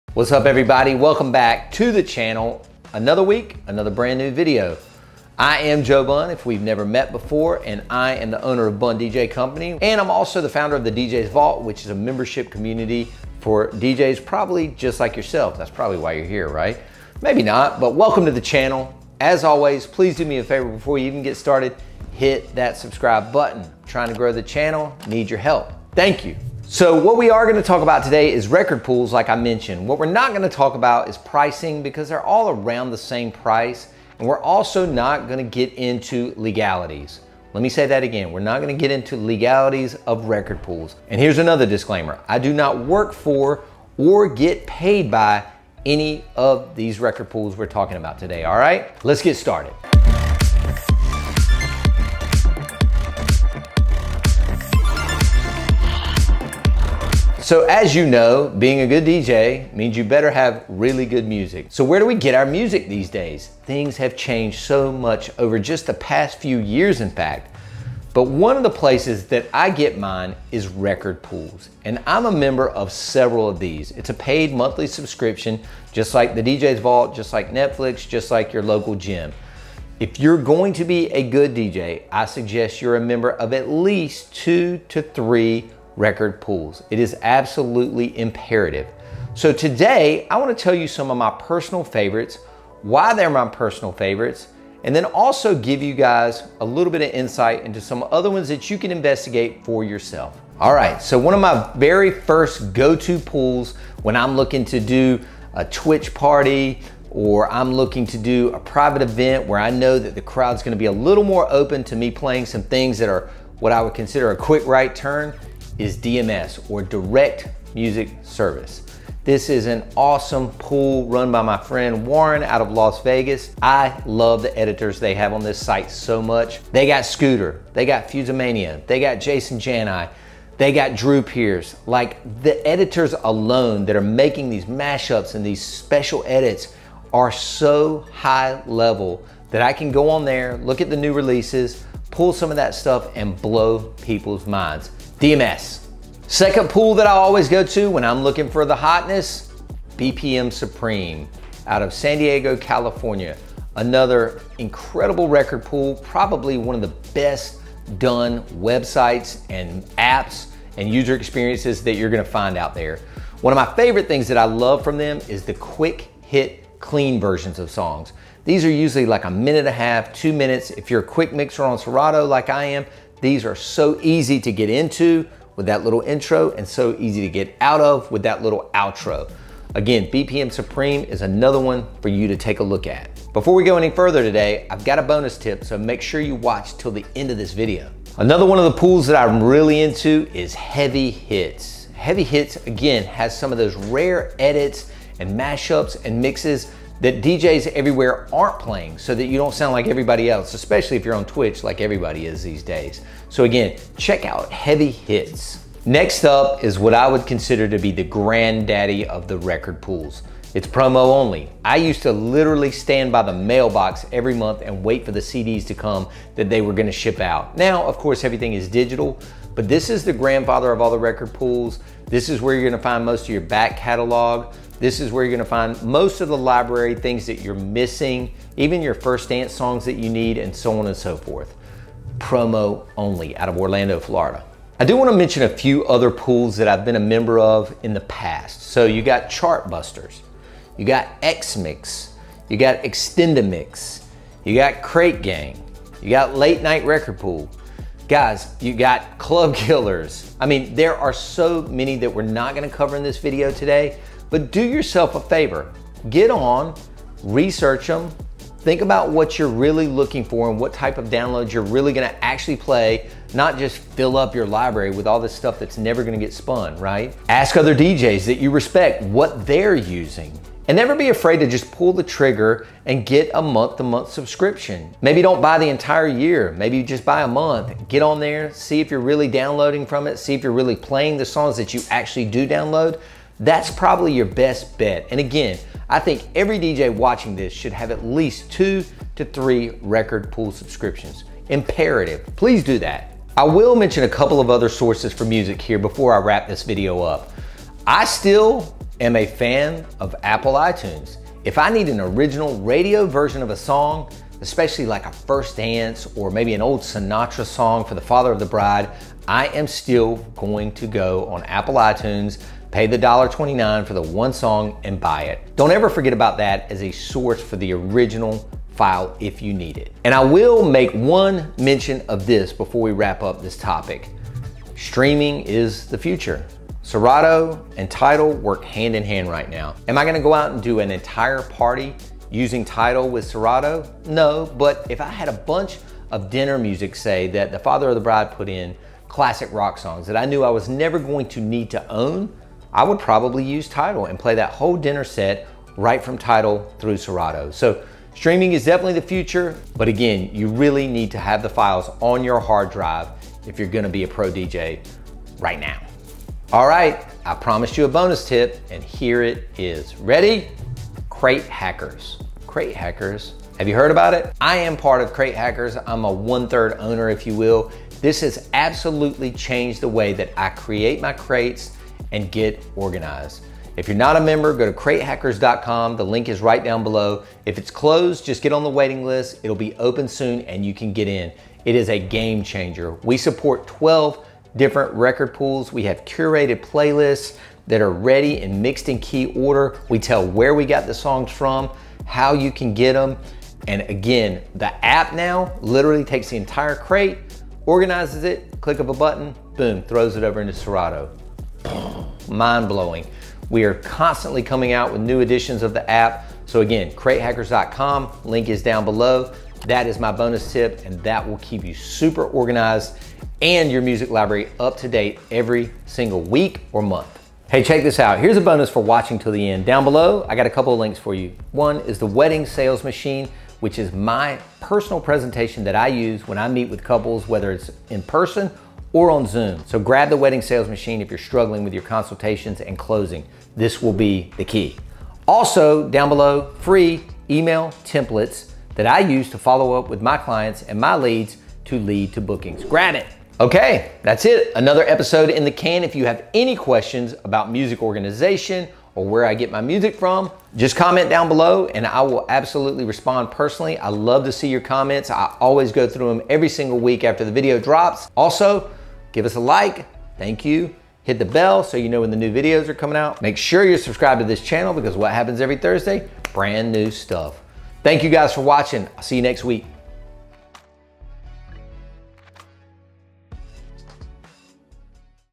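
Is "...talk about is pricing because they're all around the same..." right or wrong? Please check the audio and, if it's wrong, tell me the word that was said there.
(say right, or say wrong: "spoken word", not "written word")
right.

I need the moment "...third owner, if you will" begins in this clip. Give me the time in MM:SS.
06:06.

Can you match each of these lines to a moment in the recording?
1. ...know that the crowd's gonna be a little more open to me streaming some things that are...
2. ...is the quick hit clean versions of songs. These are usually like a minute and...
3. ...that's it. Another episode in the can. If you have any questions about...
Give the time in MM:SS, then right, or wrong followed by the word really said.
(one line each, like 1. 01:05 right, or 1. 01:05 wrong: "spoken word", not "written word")
1. 01:49 wrong: "playing", not "streaming"
2. 02:45 right
3. 07:24 right.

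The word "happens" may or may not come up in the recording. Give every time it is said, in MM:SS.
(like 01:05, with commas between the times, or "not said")
07:45.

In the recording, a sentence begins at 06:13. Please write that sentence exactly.
If you're not a member, go to cratehackers.com.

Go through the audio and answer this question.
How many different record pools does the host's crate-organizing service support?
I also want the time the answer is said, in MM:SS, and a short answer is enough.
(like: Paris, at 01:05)
12, at 06:23.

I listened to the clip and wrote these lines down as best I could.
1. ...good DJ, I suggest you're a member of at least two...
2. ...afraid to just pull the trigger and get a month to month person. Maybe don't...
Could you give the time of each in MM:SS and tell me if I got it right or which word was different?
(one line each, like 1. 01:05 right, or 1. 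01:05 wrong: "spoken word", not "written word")
1. 01:21 right
2. 04:31 wrong: "subscription", not "person".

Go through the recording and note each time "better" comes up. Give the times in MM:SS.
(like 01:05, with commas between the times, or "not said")
01:00.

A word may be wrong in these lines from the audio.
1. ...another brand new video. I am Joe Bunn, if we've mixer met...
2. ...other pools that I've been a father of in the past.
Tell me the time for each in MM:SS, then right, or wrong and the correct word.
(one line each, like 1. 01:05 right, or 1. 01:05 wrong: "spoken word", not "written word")
1. 00:03 wrong: "never", not "mixer"
2. 03:55 wrong: "member", not "father".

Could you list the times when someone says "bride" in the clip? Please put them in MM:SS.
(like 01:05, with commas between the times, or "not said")
05:08, 05:38.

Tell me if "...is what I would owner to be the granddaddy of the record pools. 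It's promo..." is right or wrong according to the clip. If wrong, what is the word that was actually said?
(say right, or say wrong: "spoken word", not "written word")
wrong: "consider", not "owner".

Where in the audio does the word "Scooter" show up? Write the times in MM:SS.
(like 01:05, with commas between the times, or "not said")
02:07.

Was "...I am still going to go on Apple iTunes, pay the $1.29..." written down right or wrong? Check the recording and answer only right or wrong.
right.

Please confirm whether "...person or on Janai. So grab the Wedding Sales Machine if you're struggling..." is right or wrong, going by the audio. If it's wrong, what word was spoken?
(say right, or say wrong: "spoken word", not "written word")
wrong: "Zoom", not "Janai".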